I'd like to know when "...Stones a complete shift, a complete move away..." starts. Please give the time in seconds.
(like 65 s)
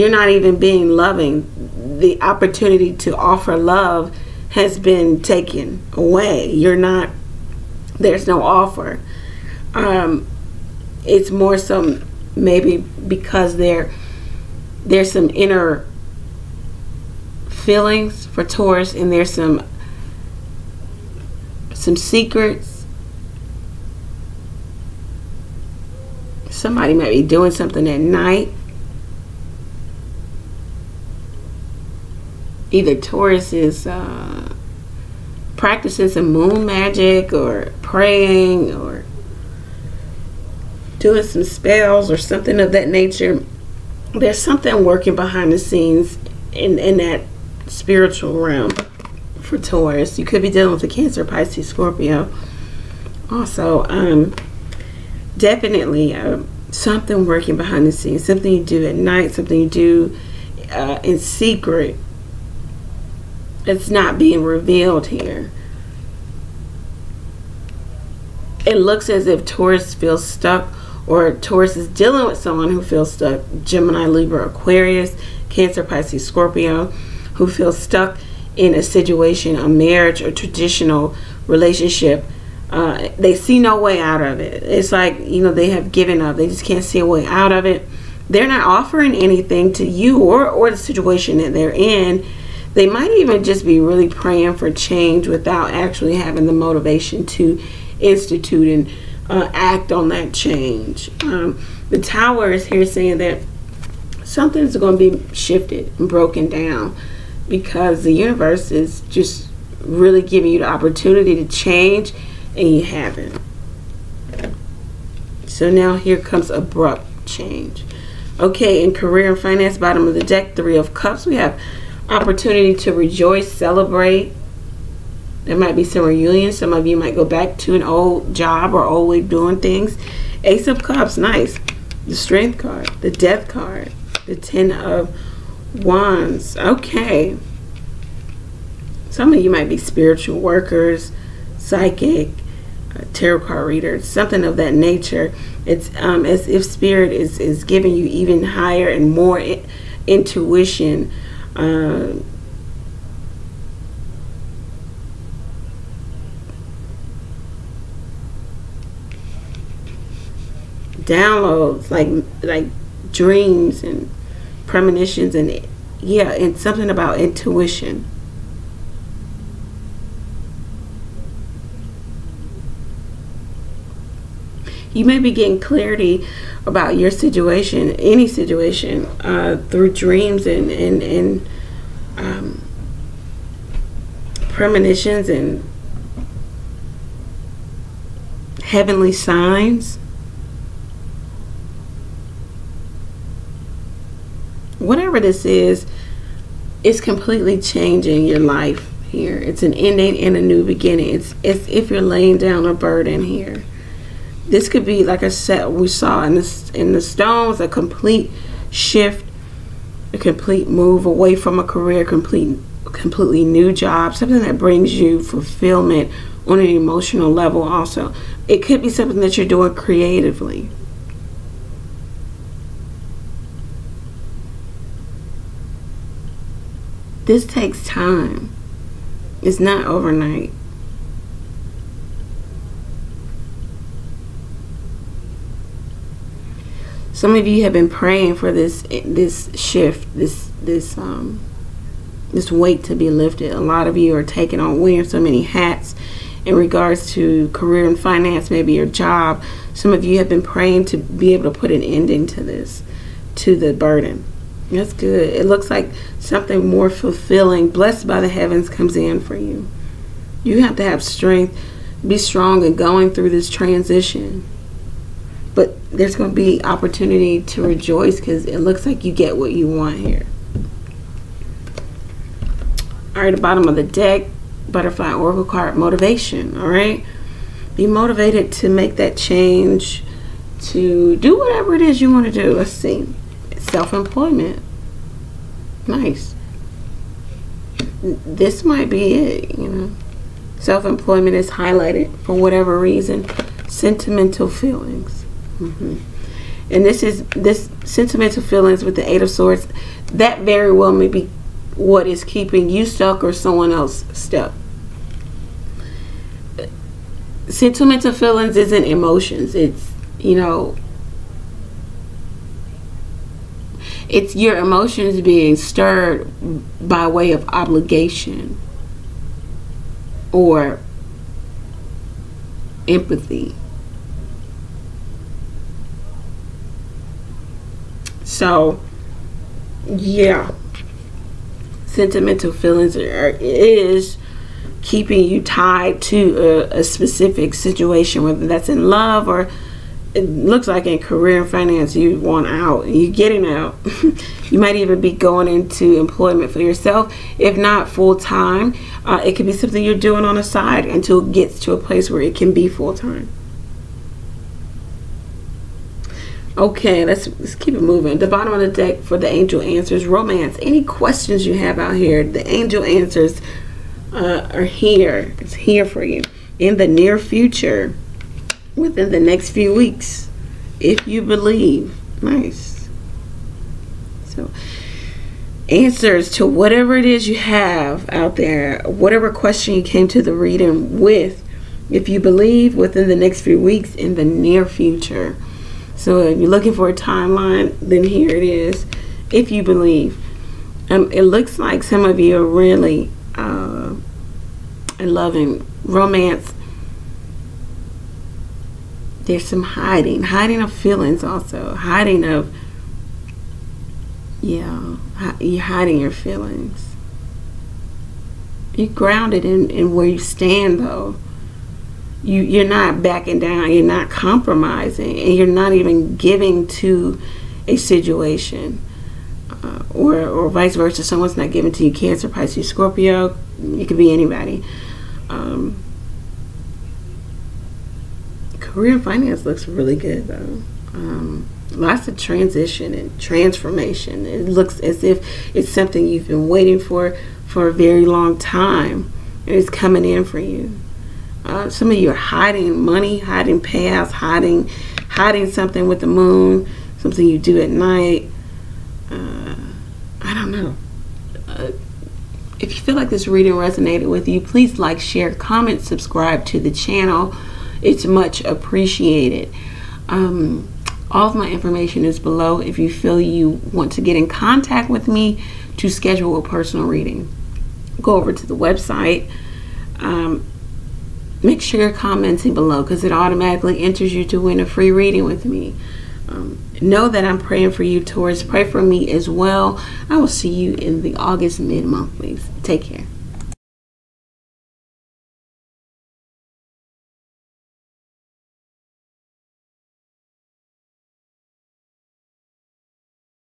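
207 s.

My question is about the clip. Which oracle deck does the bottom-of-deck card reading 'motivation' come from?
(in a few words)
Butterfly oracle.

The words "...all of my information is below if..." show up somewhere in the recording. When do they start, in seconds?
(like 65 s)
461 s.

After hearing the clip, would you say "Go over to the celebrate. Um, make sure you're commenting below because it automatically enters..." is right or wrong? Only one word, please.
wrong.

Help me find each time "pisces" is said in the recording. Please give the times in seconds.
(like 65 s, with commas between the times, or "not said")
51 s, 75 s, 422 s.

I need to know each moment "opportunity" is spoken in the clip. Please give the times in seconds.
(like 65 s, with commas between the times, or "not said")
2 s, 110 s, 122 s, 266 s.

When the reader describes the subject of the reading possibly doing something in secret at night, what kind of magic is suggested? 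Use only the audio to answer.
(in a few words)
moon magic.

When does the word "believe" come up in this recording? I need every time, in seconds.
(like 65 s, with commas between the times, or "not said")
371 s, 382 s, 389 s.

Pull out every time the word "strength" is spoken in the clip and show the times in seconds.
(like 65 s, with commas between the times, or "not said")
132 s, 261 s.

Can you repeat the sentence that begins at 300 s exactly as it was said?
That very well may be what is keeping you stuck or someone else stuck.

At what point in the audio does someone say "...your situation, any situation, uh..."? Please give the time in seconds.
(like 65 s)
176 s.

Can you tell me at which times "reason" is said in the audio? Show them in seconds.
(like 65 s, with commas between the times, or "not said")
292 s.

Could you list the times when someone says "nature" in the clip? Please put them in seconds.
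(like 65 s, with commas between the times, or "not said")
42 s, 144 s.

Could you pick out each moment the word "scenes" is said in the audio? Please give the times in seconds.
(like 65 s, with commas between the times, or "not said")
45 s, 57 s.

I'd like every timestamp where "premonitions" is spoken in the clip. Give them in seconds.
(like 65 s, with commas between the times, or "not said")
164 s, 184 s.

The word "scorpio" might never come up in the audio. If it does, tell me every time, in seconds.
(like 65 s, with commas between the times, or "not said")
51 s, 76 s, 422 s.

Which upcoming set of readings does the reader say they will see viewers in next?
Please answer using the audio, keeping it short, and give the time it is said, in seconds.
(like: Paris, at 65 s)
August mid monthlies, at 481 s.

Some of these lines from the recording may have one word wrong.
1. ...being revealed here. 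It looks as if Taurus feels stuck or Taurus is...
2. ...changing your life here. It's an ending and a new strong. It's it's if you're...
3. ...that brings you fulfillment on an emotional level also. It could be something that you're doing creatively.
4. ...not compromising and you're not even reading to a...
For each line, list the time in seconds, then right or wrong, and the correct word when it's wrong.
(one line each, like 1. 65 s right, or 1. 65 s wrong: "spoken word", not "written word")
1. 64 s right
2. 197 s wrong: "beginning", not "strong"
3. 214 s right
4. 413 s wrong: "giving", not "reading".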